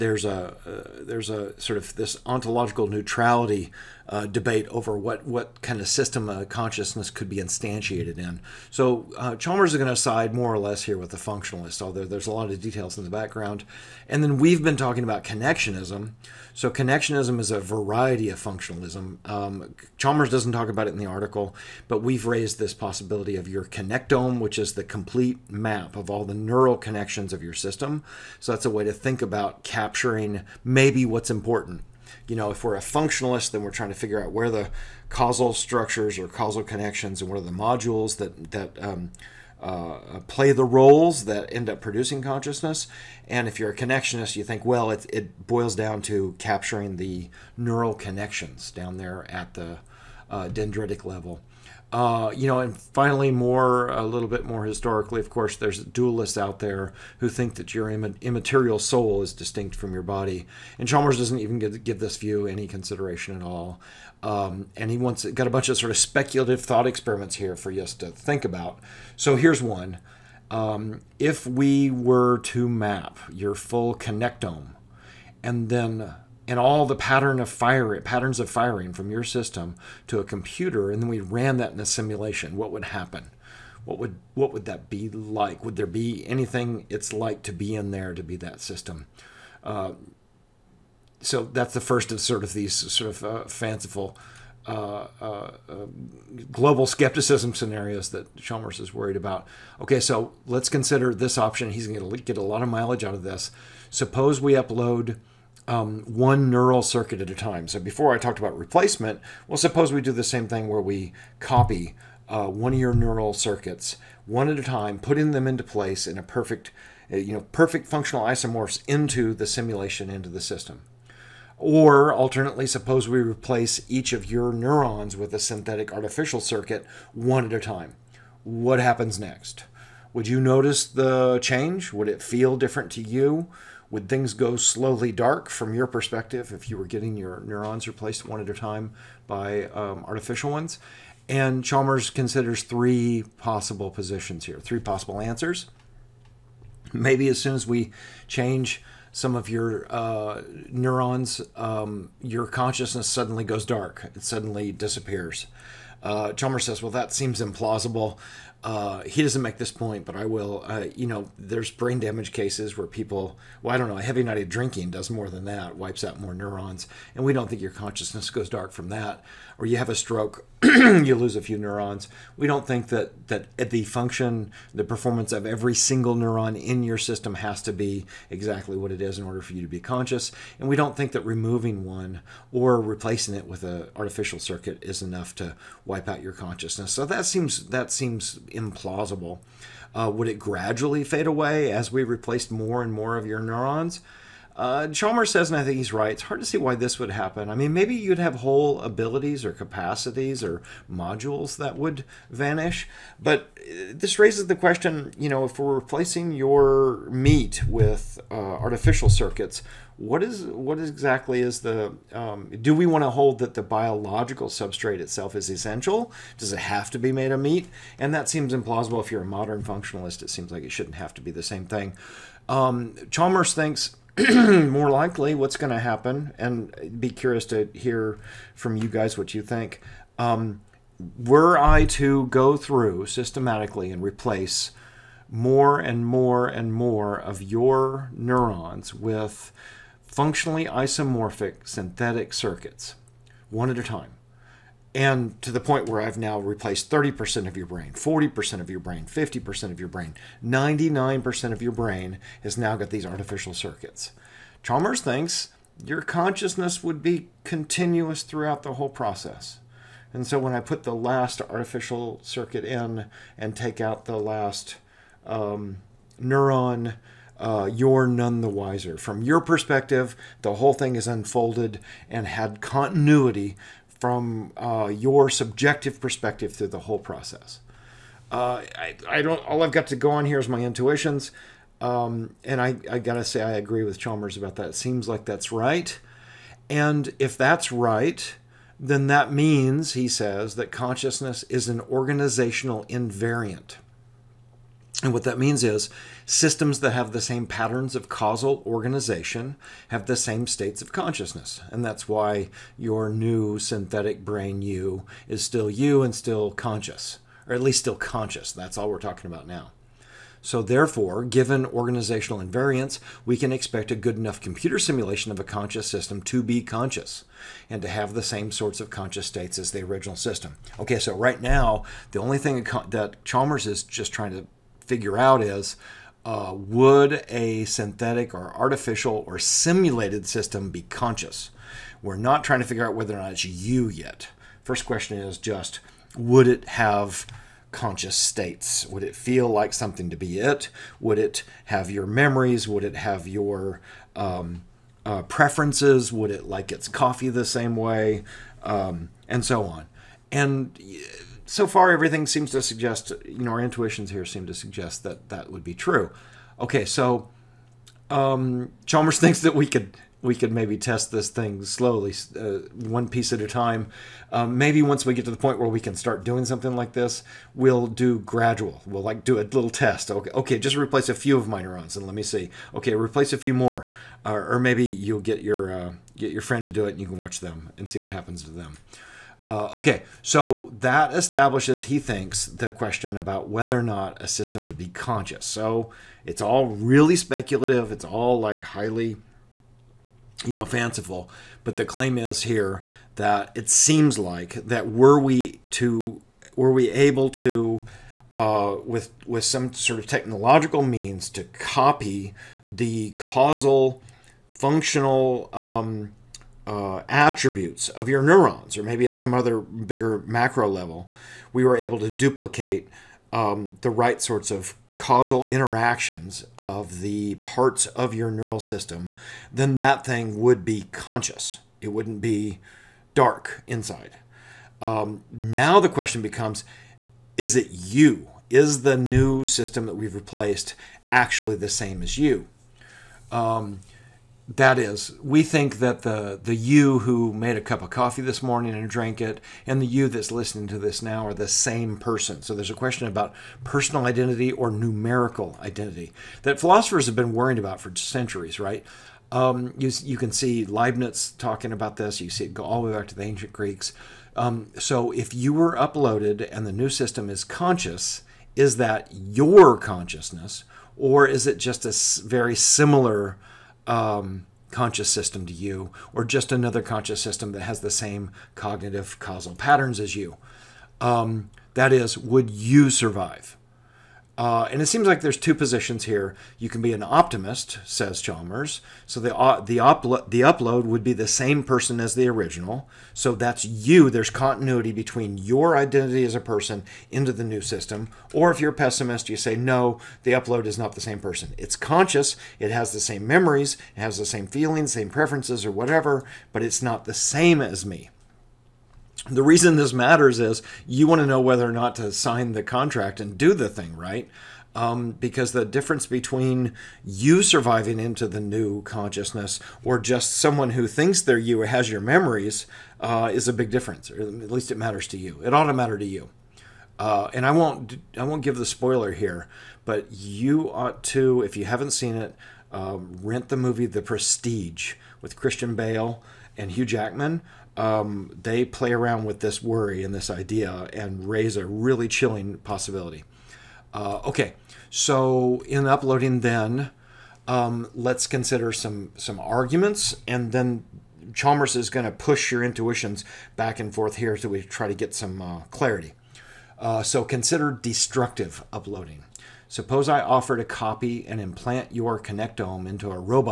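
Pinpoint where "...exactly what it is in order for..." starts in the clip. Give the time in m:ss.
2:58.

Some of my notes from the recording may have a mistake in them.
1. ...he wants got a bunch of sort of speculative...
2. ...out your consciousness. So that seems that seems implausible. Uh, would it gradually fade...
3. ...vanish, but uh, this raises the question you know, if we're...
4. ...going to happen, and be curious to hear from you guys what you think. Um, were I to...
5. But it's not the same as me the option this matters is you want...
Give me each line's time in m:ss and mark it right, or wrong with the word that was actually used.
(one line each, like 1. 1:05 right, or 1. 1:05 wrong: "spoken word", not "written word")
1. 1:04 right
2. 3:06 right
3. 3:22 right
4. 3:45 right
5. 8:16 wrong: "reason", not "option".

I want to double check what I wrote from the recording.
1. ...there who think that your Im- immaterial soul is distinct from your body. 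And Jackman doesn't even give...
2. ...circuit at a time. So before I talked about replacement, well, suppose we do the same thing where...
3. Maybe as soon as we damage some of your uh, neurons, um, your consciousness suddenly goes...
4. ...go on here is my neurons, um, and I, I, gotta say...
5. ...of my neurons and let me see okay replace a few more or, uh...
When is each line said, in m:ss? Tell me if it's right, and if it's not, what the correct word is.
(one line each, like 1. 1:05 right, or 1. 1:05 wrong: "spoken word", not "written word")
1. 0:56 wrong: "Chalmers", not "Jackman"
2. 1:46 right
3. 2:26 wrong: "change", not "damage"
4. 4:39 wrong: "intuitions", not "neurons"
5. 6:11 right.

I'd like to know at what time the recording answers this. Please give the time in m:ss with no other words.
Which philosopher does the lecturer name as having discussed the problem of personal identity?
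7:30.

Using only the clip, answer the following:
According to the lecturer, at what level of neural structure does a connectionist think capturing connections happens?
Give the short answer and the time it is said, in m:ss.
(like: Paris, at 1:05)
dendritic level, at 0:50.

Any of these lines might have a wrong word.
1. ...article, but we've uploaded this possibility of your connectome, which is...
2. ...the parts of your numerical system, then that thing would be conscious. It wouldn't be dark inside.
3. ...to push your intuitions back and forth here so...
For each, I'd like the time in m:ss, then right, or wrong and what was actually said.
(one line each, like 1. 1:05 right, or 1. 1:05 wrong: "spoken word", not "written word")
1. 0:21 wrong: "raised", not "uploaded"
2. 6:57 wrong: "neural", not "numerical"
3. 9:02 right.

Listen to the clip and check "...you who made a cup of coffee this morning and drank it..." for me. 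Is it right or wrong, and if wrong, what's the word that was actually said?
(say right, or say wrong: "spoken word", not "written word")
right.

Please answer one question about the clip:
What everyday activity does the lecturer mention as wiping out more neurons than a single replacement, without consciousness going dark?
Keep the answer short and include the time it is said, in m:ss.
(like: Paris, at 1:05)
heavy night of drinking, at 2:43.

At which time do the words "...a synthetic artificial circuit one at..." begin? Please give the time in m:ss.
2:05.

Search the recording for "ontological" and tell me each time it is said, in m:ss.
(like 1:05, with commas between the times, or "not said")
0:02.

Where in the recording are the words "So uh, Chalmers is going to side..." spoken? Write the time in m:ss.
0:08.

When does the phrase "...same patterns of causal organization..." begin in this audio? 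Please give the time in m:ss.
4:57.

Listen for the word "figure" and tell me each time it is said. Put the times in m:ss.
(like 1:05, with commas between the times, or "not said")
0:33, 5:24, 5:32.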